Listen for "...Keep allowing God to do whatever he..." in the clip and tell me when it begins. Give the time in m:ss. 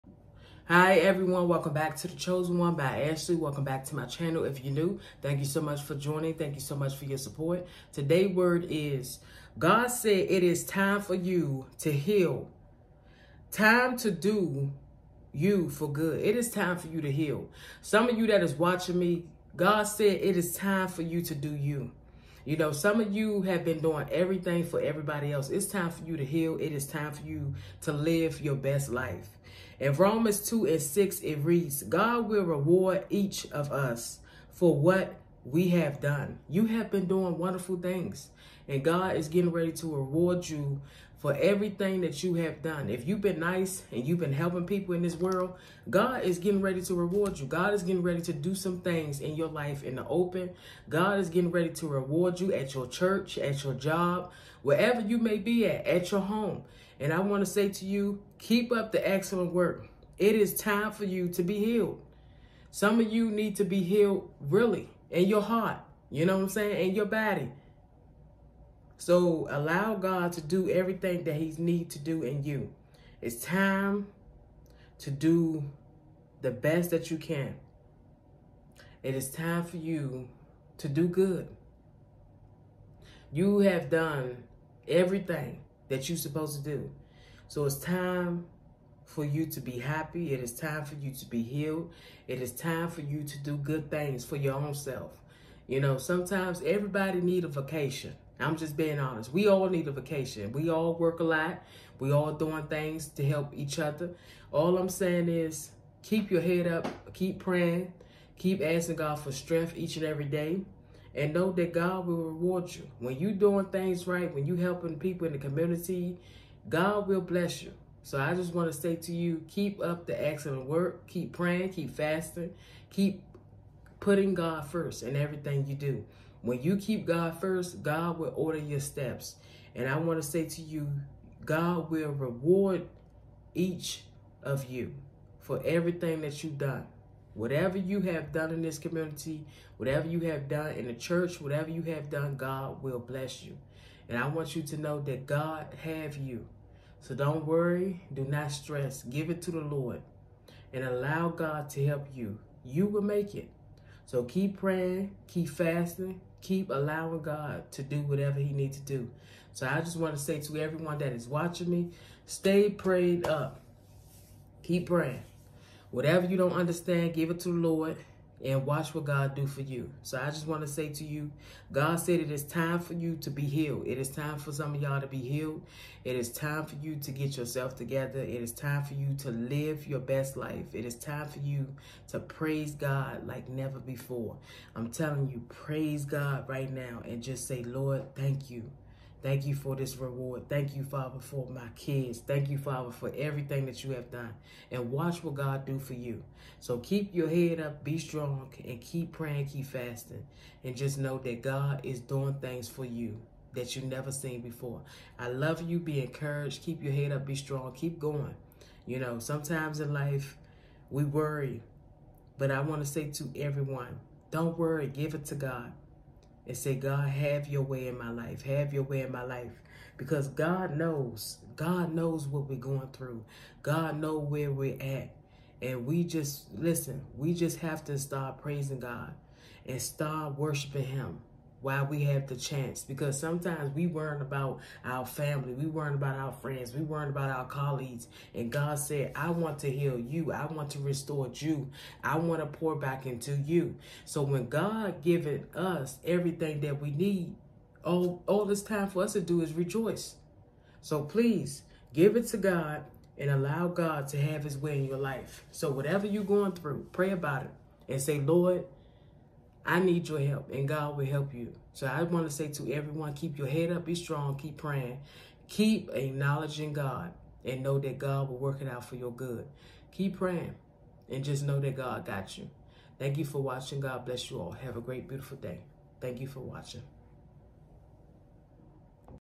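2:36.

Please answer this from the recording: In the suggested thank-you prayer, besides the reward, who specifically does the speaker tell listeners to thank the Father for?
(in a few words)
My kids.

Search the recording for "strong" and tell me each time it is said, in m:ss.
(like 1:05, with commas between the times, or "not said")
3:17, 3:27, 4:23.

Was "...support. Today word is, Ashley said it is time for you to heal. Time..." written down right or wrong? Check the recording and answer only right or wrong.
wrong.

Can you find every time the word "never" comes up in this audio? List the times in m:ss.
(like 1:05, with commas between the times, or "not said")
3:03, 3:23.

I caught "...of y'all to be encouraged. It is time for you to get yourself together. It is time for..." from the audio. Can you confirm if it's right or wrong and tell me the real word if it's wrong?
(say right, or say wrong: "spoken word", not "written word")
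wrong: "healed", not "encouraged".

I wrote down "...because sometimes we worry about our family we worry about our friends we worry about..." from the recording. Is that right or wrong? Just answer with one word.
right.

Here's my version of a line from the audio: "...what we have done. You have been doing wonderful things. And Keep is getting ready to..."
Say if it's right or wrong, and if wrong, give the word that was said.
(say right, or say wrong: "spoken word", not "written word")
wrong: "God", not "Keep".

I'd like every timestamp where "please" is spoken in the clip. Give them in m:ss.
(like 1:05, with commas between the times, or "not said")
4:11.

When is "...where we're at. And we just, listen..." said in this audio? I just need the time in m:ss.
3:44.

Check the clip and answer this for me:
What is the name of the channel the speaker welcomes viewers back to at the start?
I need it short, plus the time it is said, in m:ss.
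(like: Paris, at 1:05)
The Chosen One by Ashley, at 0:02.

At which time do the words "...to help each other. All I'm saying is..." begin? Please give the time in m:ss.
1:43.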